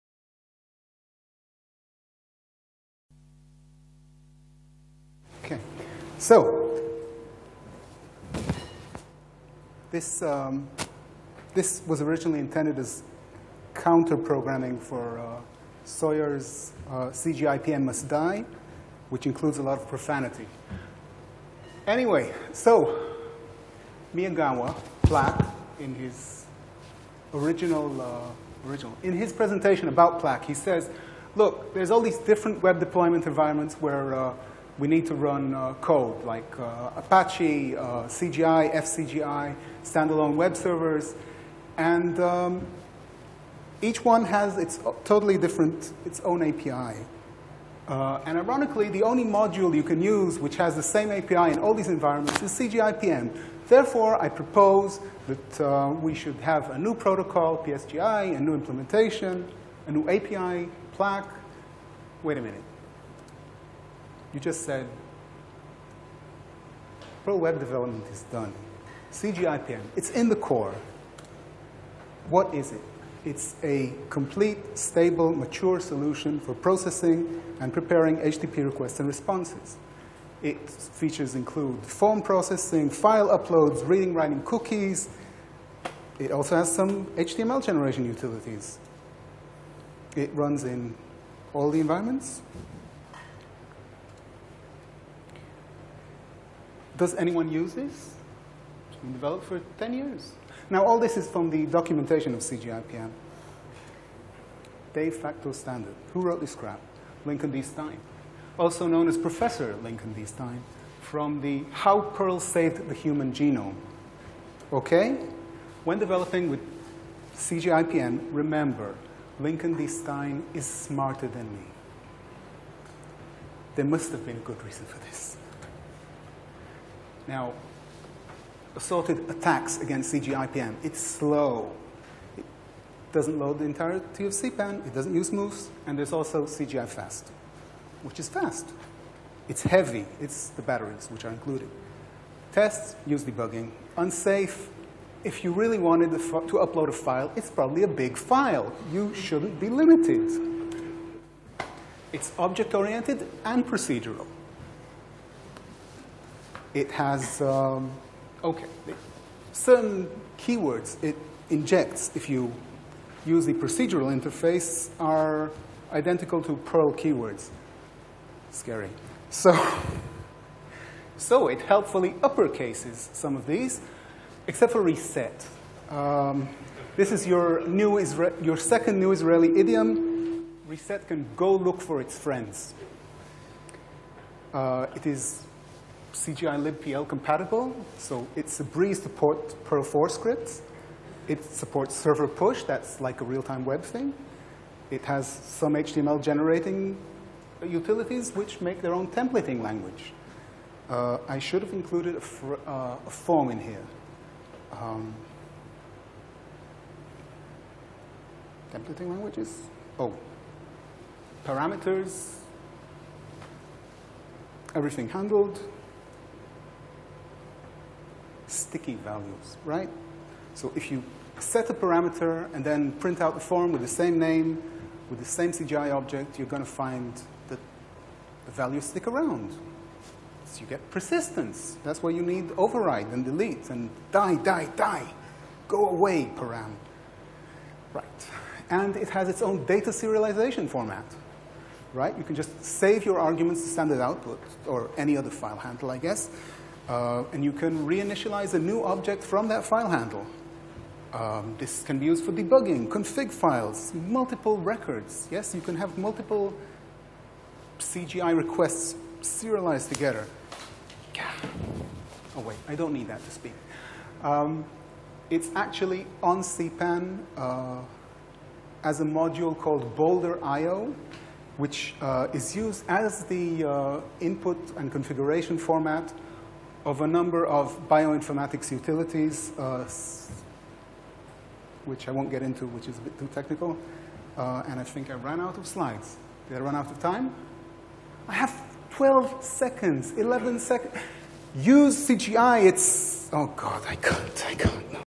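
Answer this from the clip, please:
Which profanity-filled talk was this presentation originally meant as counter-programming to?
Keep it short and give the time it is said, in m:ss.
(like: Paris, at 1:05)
CGI.pm Must Die, at 0:17.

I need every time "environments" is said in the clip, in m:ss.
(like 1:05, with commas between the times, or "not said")
0:33, 0:51, 1:31.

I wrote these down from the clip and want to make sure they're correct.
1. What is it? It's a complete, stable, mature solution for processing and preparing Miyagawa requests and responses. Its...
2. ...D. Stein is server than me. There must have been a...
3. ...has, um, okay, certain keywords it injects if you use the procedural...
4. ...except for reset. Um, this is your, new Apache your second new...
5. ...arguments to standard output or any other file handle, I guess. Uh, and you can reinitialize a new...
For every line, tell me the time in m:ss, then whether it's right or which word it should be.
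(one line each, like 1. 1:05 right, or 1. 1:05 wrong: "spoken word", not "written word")
1. 1:12 wrong: "HTTP", not "Miyagawa"
2. 1:59 wrong: "smarter", not "server"
3. 2:36 right
4. 2:54 wrong: "Isra", not "Apache"
5. 4:03 right.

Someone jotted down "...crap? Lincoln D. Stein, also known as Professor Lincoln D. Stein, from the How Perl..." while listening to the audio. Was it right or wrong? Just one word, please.
right.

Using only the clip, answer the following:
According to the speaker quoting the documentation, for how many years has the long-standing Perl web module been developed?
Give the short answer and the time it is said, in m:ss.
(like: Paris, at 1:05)
10 years, at 1:39.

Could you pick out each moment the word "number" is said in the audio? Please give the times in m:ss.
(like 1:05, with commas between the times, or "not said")
4:37.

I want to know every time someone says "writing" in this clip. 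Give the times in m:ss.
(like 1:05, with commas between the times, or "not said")
1:24.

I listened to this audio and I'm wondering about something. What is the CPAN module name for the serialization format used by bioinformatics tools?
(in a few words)
Boulder IO.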